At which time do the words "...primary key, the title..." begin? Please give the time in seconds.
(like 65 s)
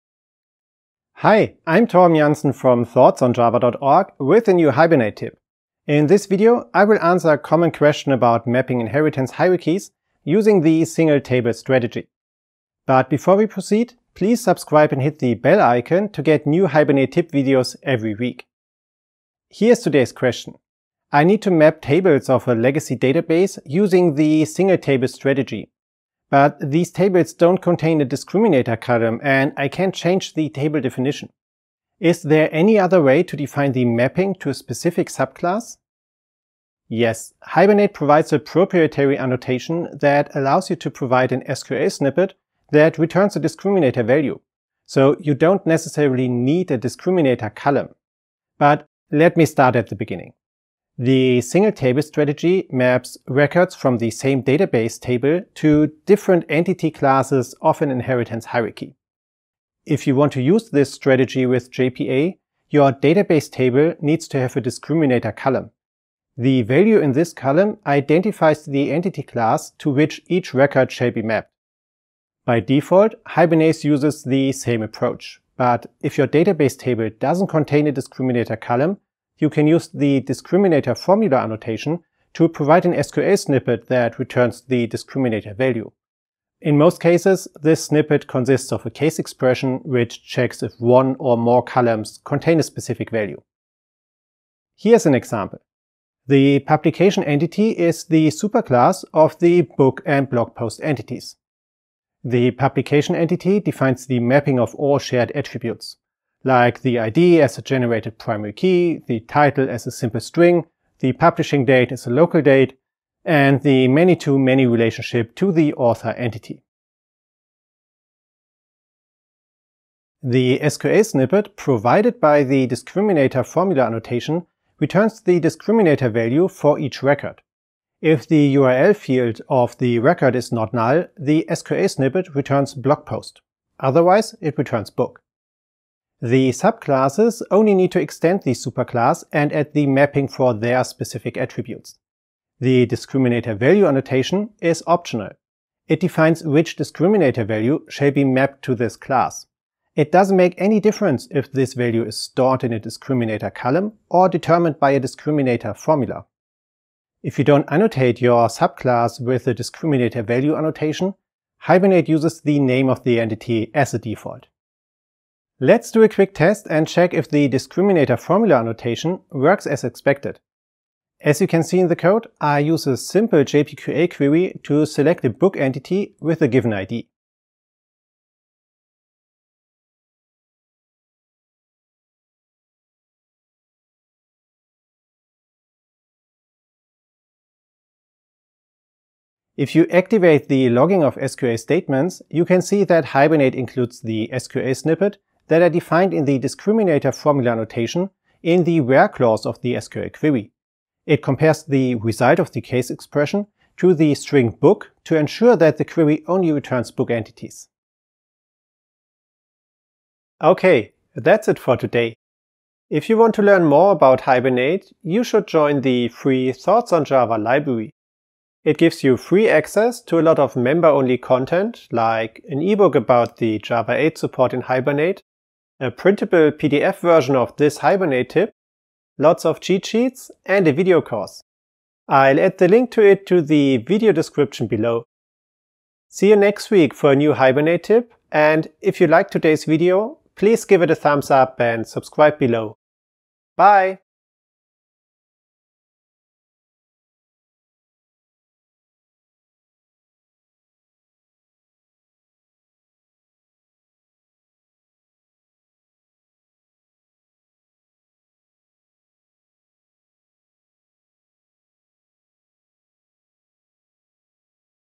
108 s.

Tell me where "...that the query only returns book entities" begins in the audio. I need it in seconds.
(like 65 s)
205 s.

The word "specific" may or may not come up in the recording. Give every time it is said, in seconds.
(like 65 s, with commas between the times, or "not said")
34 s, 92 s, 140 s.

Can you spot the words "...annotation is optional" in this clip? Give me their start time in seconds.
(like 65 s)
143 s.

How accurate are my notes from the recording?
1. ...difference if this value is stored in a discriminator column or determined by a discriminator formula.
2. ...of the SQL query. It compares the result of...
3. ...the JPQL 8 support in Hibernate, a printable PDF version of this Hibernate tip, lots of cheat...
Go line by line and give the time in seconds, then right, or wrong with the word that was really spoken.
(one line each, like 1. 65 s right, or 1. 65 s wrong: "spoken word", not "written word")
1. 150 s right
2. 199 s right
3. 223 s wrong: "Java", not "JPQL".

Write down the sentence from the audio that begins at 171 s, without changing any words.
As you can see in the code, I use a simple JPQL query to select a book entity with a given ID.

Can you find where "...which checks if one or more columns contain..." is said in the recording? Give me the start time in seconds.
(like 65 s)
89 s.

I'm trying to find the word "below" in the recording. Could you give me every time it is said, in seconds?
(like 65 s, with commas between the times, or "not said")
234 s, 242 s.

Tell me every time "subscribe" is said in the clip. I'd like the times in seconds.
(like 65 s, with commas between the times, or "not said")
14 s, 241 s.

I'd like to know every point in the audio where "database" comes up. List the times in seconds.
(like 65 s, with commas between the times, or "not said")
22 s, 54 s, 62 s, 76 s.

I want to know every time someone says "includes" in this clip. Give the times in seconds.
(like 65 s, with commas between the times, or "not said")
193 s.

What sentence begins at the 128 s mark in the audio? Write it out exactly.
If the URL field of the record is not null, the SQL snippet returns blog post.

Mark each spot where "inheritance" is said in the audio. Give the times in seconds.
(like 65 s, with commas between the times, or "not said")
8 s, 57 s.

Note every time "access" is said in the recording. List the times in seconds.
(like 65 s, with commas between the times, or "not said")
219 s.